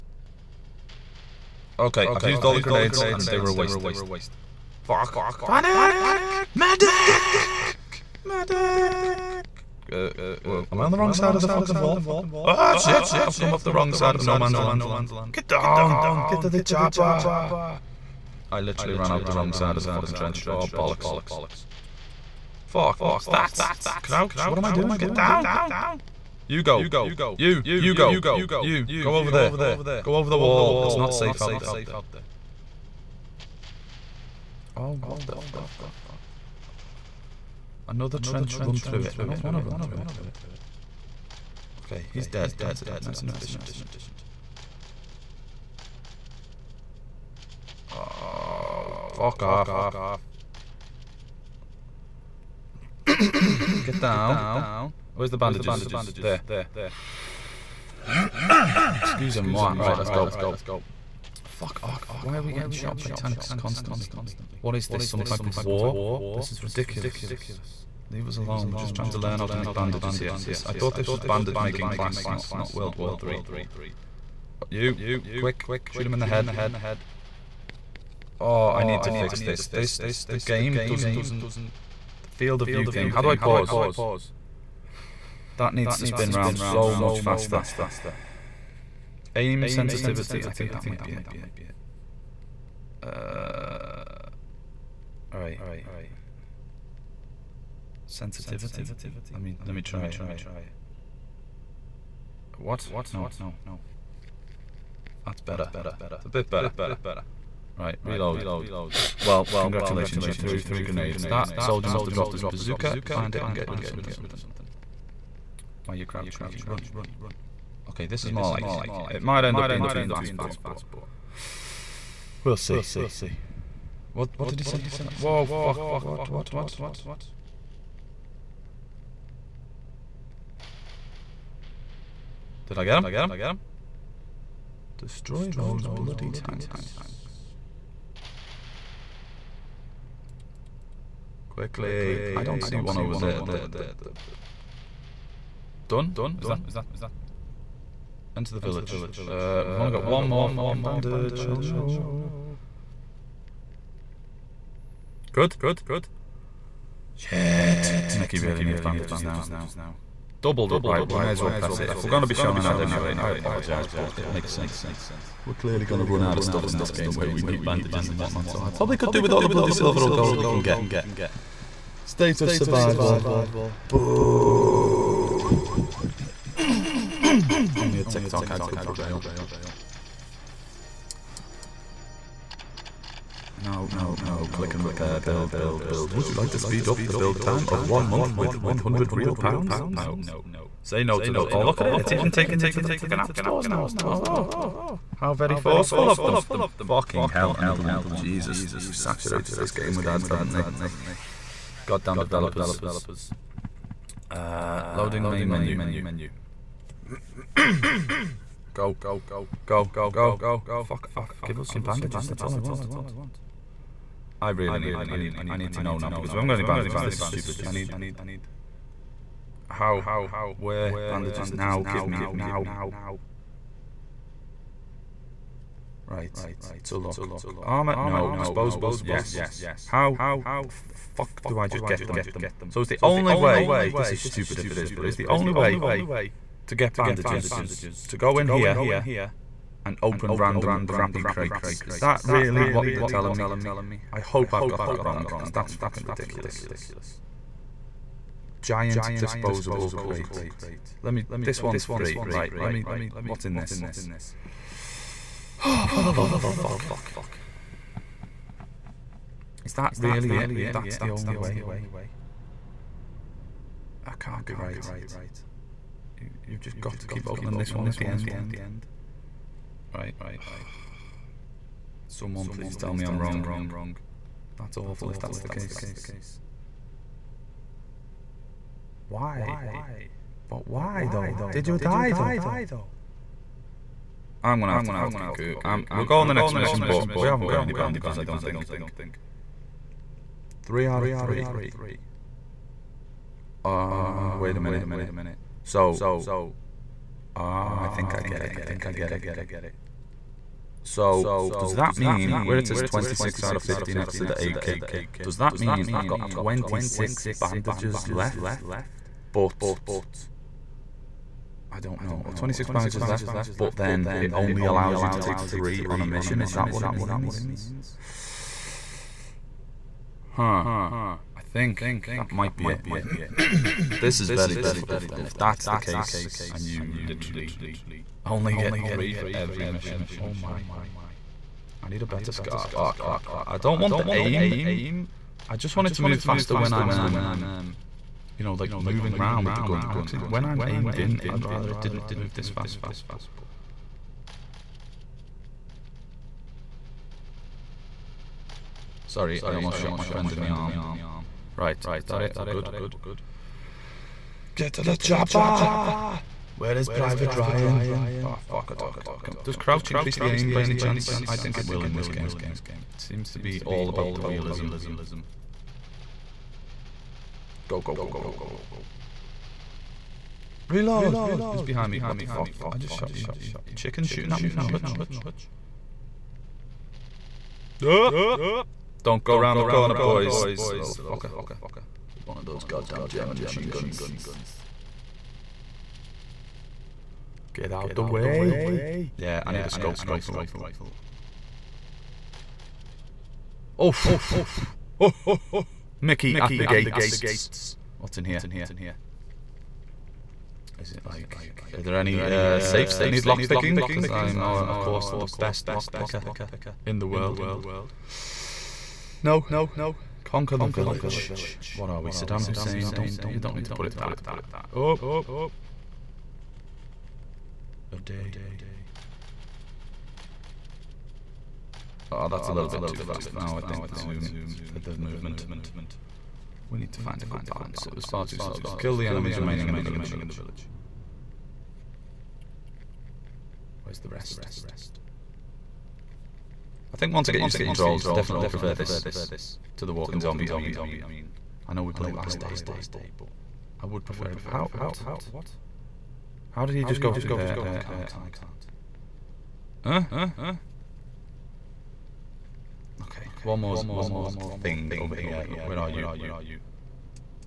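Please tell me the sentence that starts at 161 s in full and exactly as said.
If we're going to be shown an ad anyway, I apologise, but it makes sense.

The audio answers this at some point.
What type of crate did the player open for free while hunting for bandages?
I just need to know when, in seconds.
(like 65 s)
248 s.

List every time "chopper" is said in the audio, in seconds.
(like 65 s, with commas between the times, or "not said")
16 s, 354 s.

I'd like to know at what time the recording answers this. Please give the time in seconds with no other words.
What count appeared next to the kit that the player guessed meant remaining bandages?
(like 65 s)
302 s.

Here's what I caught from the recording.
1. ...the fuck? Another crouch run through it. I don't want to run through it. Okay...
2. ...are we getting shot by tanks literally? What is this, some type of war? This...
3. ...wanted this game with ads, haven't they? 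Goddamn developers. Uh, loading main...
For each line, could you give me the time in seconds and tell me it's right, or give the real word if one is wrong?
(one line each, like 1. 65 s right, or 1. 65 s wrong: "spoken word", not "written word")
1. 35 s wrong: "trench", not "crouch"
2. 62 s wrong: "constantly", not "literally"
3. 198 s wrong: "saturated", not "wanted".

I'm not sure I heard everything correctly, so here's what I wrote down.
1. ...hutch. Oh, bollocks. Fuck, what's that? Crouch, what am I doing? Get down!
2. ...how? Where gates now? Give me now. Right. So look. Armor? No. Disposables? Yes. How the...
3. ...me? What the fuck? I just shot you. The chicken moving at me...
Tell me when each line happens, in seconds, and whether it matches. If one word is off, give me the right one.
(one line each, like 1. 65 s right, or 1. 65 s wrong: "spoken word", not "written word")
1. 20 s wrong: "trench", not "hutch"
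2. 219 s wrong: "bandages", not "gates"
3. 371 s wrong: "shooting", not "moving".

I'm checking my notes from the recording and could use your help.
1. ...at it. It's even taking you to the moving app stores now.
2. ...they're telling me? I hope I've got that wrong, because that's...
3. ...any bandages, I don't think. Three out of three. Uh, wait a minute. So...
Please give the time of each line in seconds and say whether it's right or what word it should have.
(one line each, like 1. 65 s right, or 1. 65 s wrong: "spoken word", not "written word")
1. 191 s wrong: "fucking", not "moving"
2. 242 s right
3. 287 s right.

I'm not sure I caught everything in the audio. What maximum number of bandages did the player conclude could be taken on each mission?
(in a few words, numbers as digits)
3.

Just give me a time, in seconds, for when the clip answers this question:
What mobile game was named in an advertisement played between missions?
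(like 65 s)
172 s.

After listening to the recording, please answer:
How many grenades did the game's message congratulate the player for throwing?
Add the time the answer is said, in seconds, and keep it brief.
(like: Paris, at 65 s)
3, at 110 s.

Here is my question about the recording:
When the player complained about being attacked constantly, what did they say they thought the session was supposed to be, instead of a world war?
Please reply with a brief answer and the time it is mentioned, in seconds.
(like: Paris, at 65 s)
Bandage making class, at 71 s.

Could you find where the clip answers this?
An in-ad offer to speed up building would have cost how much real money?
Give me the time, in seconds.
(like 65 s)
188 s.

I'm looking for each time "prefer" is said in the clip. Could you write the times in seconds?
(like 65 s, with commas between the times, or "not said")
438 s, 444 s.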